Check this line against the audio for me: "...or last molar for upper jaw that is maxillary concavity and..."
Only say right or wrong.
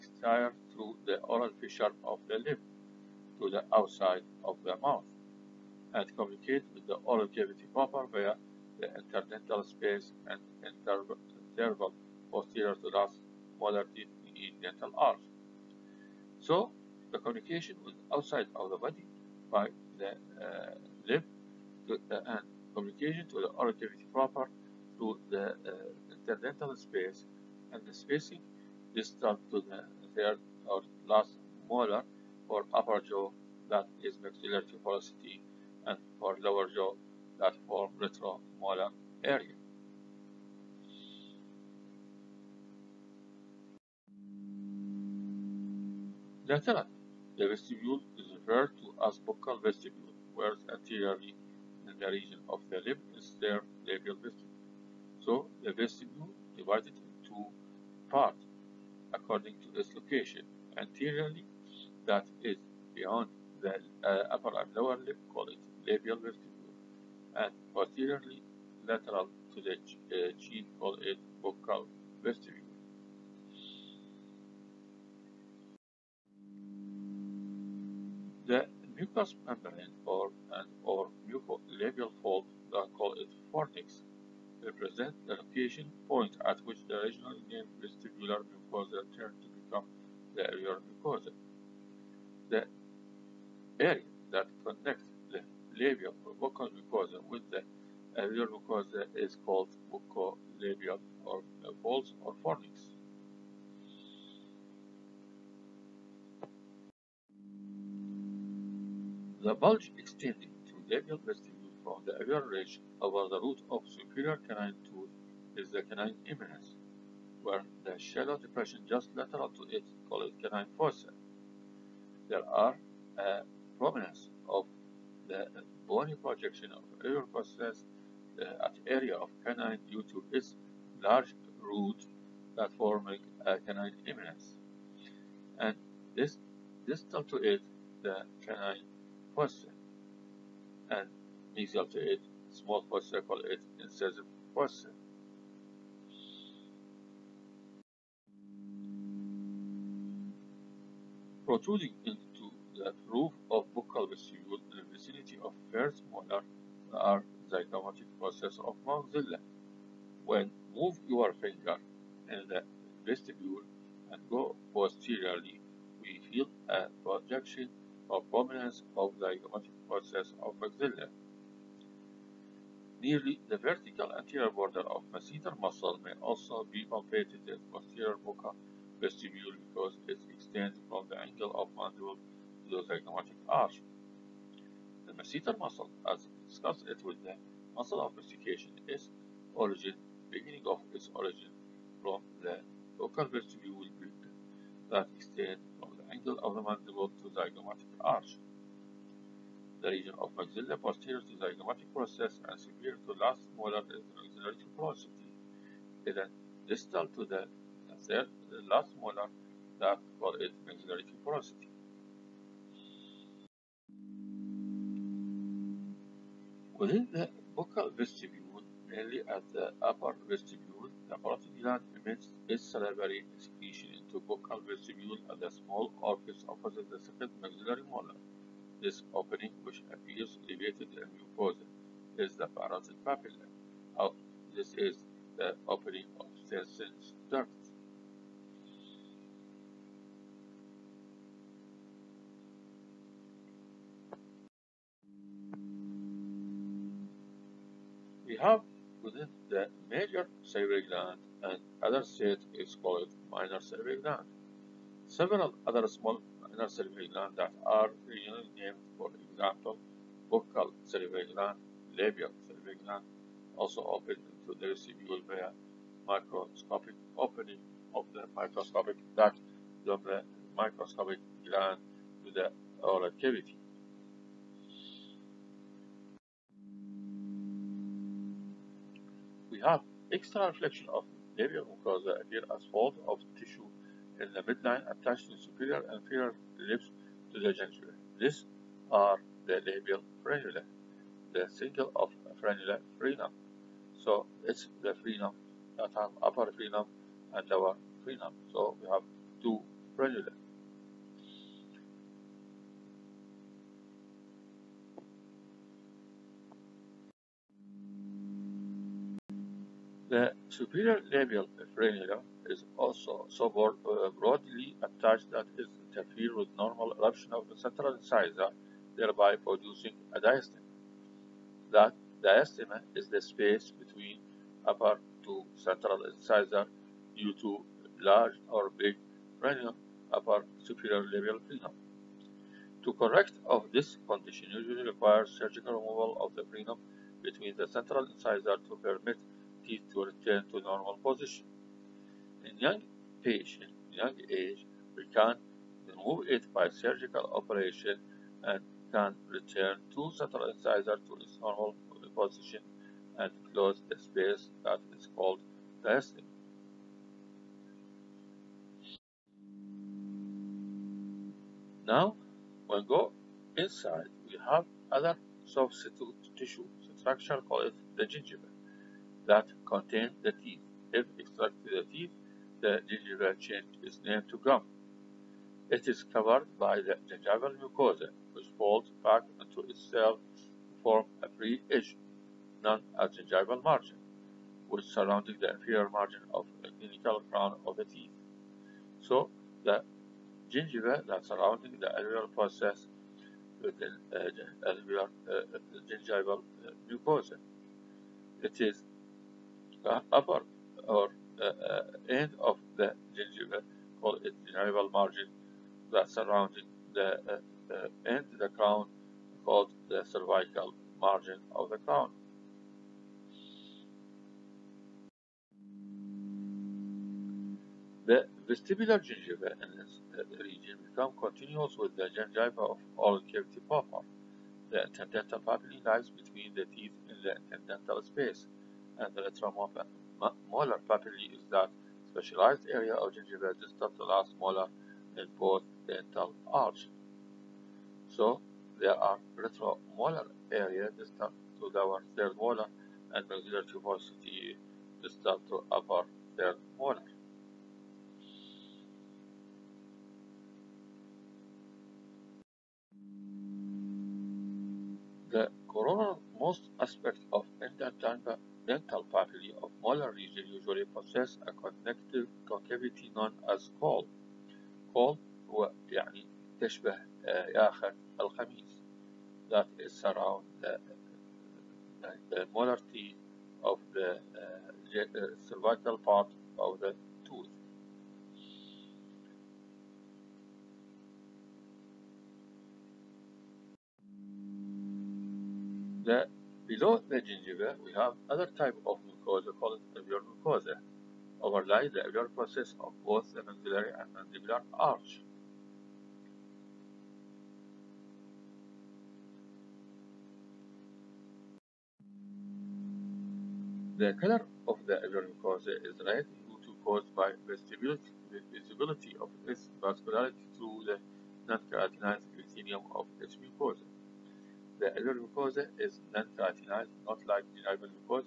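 wrong.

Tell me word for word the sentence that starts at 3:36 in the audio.
Within the buccal vestibule, mainly at the upper vestibule.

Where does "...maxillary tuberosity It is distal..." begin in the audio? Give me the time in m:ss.
3:24.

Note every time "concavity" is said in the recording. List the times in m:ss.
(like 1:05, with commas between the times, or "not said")
7:42.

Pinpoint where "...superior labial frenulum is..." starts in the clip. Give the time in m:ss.
5:10.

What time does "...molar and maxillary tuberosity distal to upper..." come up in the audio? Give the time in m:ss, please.
7:22.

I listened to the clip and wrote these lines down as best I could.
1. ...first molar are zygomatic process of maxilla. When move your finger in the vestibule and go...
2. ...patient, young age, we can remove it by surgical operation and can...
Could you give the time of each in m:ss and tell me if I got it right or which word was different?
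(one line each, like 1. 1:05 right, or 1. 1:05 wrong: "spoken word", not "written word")
1. 2:35 right
2. 5:43 right.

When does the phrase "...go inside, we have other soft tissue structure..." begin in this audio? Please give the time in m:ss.
6:02.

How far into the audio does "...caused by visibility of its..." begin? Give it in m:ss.
8:26.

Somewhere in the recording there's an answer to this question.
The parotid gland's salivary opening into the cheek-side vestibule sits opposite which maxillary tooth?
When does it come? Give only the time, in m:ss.
3:46.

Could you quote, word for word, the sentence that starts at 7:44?
call هو يعني تشبه آخر الخميس that is around the, the molar teeth of the uh, cervical part of the tooth.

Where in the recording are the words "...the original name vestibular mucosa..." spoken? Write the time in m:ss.
1:26.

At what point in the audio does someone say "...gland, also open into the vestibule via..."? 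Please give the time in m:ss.
4:22.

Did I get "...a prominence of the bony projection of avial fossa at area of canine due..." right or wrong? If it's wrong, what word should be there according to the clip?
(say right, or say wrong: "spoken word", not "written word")
right.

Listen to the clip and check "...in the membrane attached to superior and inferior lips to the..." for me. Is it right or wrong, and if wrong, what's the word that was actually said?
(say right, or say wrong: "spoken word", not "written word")
wrong: "midline", not "membrane".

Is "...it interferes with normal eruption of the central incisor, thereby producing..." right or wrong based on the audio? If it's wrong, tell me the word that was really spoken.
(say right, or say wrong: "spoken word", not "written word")
right.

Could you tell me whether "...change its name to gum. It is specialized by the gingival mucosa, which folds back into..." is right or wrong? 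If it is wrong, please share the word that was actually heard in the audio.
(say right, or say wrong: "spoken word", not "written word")
wrong: "covered", not "specialized".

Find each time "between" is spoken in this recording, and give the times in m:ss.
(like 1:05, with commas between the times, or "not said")
5:23, 5:37, 7:06.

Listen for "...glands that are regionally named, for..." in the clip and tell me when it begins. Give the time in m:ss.
4:17.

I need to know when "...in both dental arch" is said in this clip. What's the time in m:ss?
7:15.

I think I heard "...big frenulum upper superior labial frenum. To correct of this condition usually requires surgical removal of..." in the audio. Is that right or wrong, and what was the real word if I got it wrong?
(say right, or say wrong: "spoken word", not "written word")
right.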